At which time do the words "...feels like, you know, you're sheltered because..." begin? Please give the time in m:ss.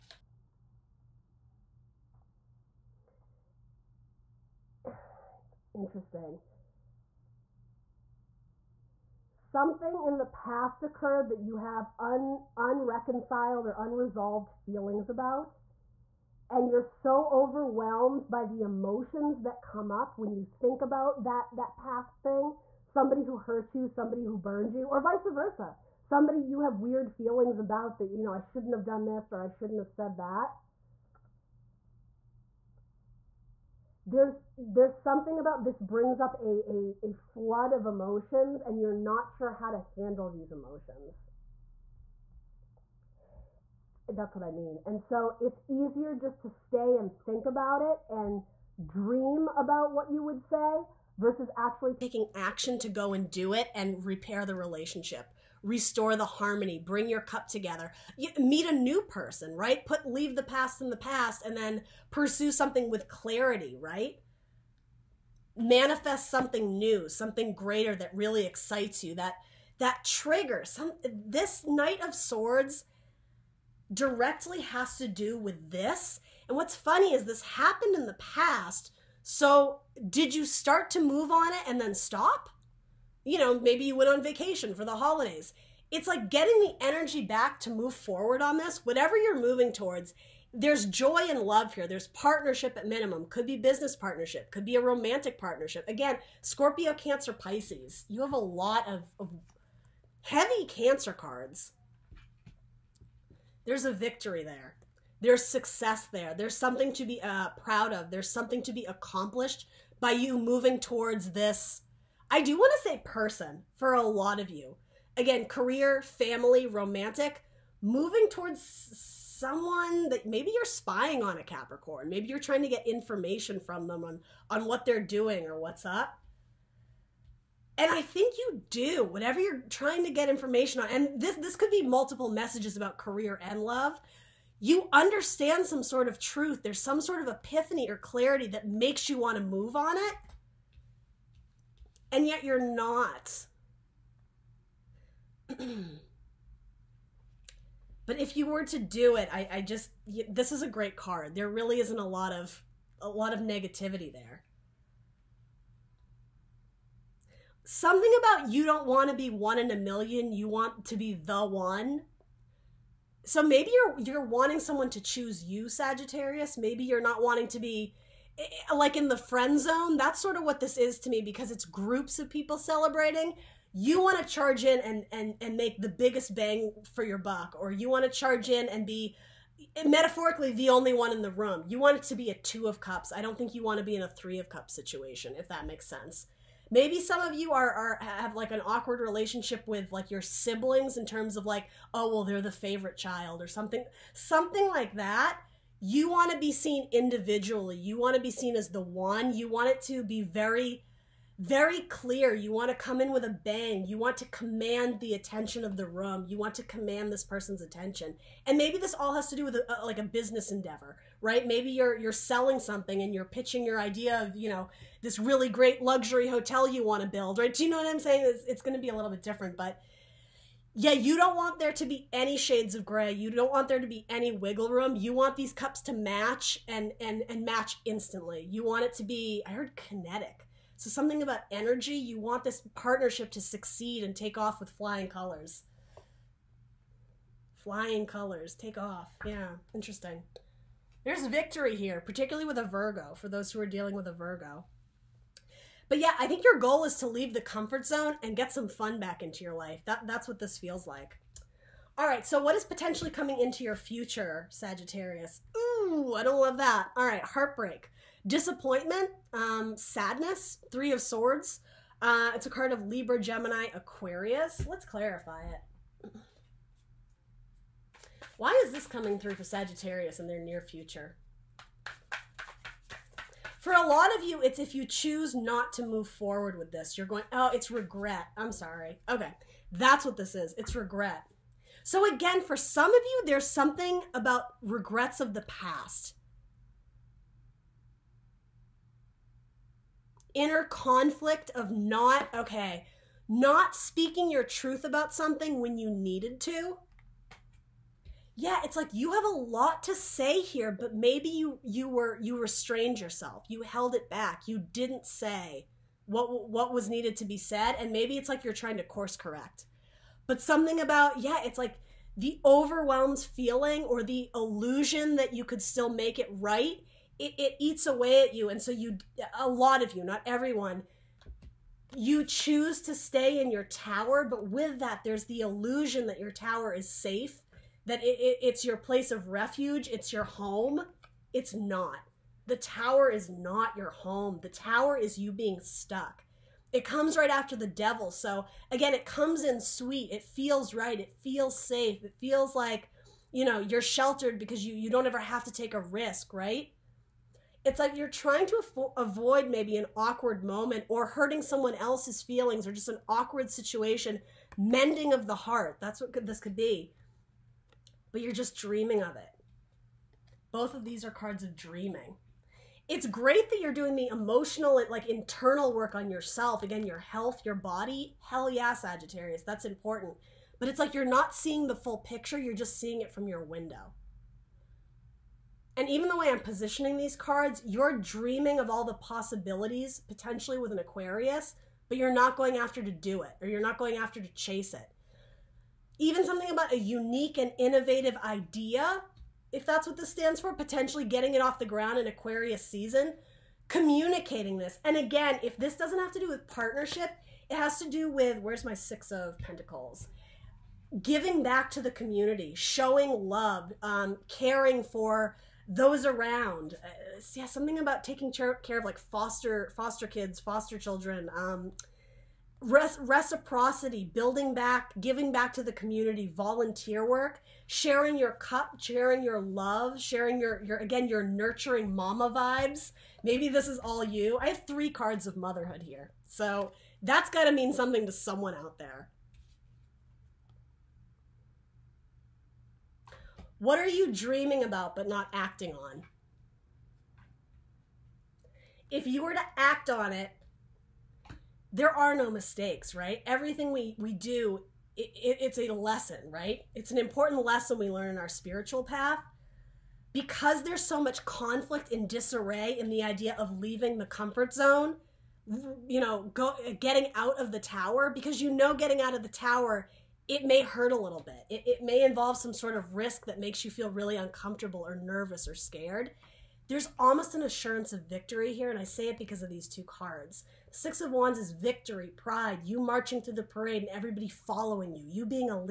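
5:42.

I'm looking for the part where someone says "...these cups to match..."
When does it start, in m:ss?
3:45.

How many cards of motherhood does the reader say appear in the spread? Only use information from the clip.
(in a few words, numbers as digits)
3.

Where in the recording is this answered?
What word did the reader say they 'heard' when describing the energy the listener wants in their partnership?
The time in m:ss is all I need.
3:49.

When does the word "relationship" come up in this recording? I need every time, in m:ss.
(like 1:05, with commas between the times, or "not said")
0:54, 3:08.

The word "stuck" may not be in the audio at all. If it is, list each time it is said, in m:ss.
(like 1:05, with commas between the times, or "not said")
5:35.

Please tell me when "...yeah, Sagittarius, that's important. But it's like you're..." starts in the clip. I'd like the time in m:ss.
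6:08.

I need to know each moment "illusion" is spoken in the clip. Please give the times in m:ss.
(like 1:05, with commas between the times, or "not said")
5:14, 5:25.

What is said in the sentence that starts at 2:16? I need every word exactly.
There's some sort of epiphany or clarity that makes you want to move on it and yet you're not.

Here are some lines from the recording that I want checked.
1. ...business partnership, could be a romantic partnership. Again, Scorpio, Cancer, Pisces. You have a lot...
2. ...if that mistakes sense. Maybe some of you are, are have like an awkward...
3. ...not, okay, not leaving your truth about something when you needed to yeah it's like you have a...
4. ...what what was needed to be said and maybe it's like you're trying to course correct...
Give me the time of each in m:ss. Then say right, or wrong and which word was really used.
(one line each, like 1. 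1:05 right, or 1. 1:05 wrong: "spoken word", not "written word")
1. 1:33 right
2. 3:05 wrong: "makes", not "mistakes"
3. 4:51 wrong: "speaking", not "leaving"
4. 5:06 right.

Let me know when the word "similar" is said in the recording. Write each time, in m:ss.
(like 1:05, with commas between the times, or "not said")
not said.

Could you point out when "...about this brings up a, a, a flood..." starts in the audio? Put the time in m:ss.
0:35.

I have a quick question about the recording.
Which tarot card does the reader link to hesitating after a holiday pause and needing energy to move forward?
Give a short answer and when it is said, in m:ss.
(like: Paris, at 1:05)
Knight of Swords, at 1:11.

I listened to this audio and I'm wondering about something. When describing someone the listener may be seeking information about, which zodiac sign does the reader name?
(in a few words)
Capricorn.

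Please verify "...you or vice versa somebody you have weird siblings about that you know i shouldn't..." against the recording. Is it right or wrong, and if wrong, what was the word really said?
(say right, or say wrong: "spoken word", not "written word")
wrong: "feelings", not "siblings".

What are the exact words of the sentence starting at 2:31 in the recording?
There really isn't a lot of a lot of negativity there.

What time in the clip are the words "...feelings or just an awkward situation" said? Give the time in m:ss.
5:52.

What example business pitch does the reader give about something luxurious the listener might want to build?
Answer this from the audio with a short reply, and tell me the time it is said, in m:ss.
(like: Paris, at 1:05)
luxury hotel, at 3:35.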